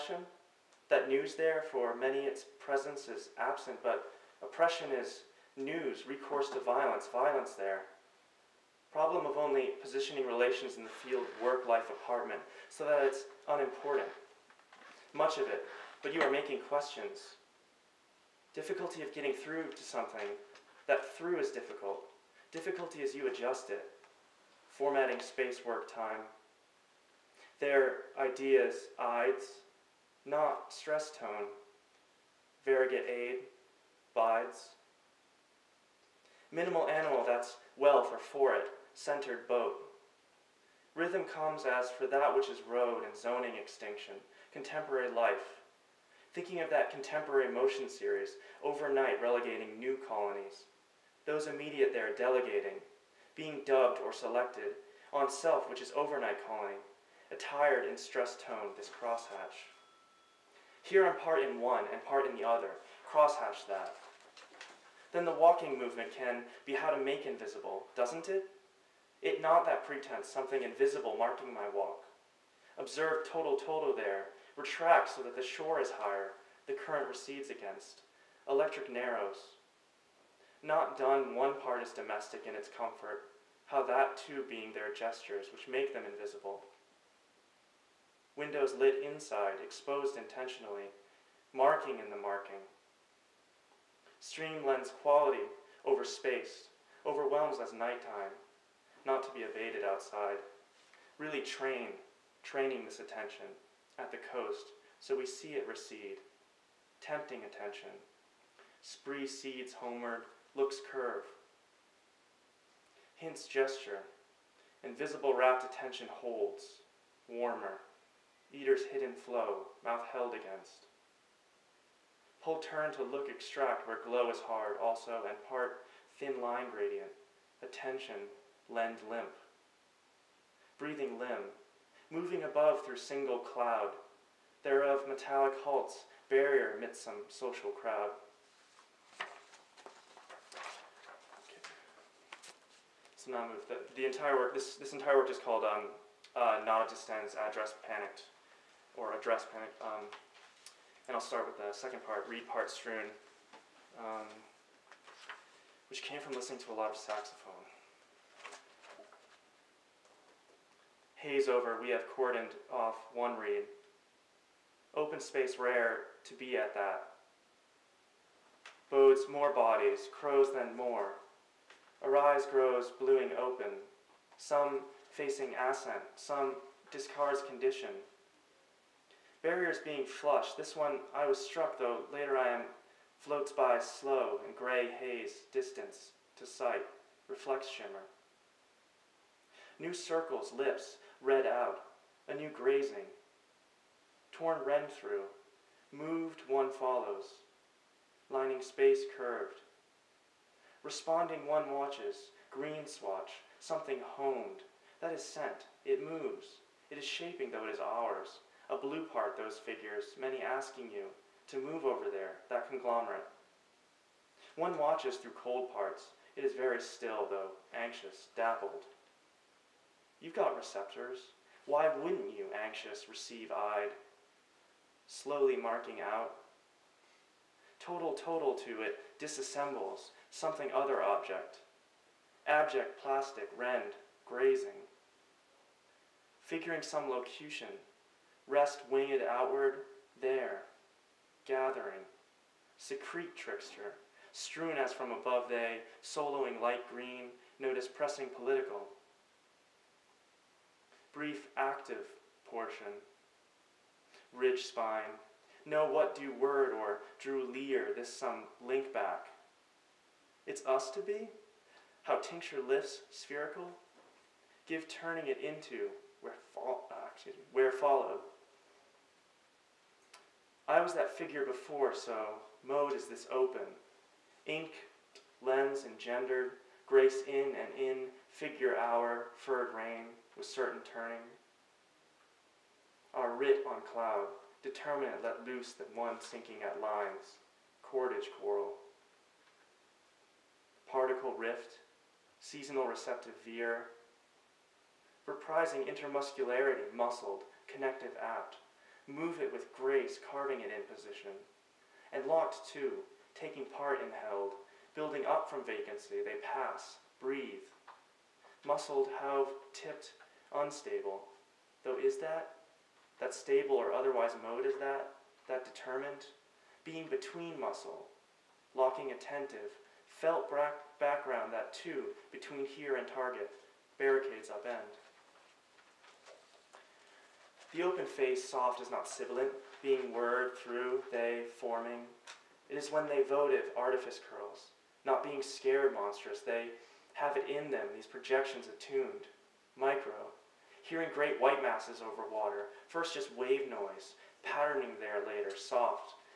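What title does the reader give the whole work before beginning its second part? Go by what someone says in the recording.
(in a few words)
Nod Address Panicked.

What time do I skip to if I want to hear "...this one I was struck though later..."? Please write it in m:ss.
3:00.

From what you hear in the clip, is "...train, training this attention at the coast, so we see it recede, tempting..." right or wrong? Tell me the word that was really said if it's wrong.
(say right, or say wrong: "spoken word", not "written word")
right.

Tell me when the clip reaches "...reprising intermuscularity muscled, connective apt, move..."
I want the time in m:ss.
4:55.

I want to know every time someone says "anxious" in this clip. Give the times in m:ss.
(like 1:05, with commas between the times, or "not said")
3:37, 3:42.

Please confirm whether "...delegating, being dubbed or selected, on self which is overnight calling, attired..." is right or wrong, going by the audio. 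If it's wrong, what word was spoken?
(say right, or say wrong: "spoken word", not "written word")
right.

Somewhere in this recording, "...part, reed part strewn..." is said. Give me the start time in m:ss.
2:32.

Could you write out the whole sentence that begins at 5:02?
And locked too, taking part in held, building up from vacancy, they pass, breathe.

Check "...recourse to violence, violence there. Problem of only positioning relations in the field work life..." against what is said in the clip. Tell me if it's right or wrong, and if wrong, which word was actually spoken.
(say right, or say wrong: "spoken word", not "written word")
right.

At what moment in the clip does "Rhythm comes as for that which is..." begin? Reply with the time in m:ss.
0:40.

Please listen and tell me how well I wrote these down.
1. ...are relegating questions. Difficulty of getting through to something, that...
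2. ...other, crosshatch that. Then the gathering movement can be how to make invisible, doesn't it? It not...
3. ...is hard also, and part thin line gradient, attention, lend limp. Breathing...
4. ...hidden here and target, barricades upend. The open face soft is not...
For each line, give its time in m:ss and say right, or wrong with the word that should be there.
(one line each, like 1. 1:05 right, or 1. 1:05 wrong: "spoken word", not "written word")
1. 0:16 wrong: "making", not "relegating"
2. 1:02 wrong: "walking", not "gathering"
3. 2:04 right
4. 5:22 wrong: "between", not "hidden".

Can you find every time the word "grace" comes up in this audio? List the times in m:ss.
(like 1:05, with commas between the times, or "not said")
4:36, 4:59.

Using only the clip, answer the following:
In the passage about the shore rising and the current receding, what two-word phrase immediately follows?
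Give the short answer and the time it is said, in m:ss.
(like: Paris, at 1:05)
Electric narrows, at 1:18.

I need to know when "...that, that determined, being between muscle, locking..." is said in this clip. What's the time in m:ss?
5:14.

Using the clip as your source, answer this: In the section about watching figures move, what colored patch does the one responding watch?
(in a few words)
green swatch.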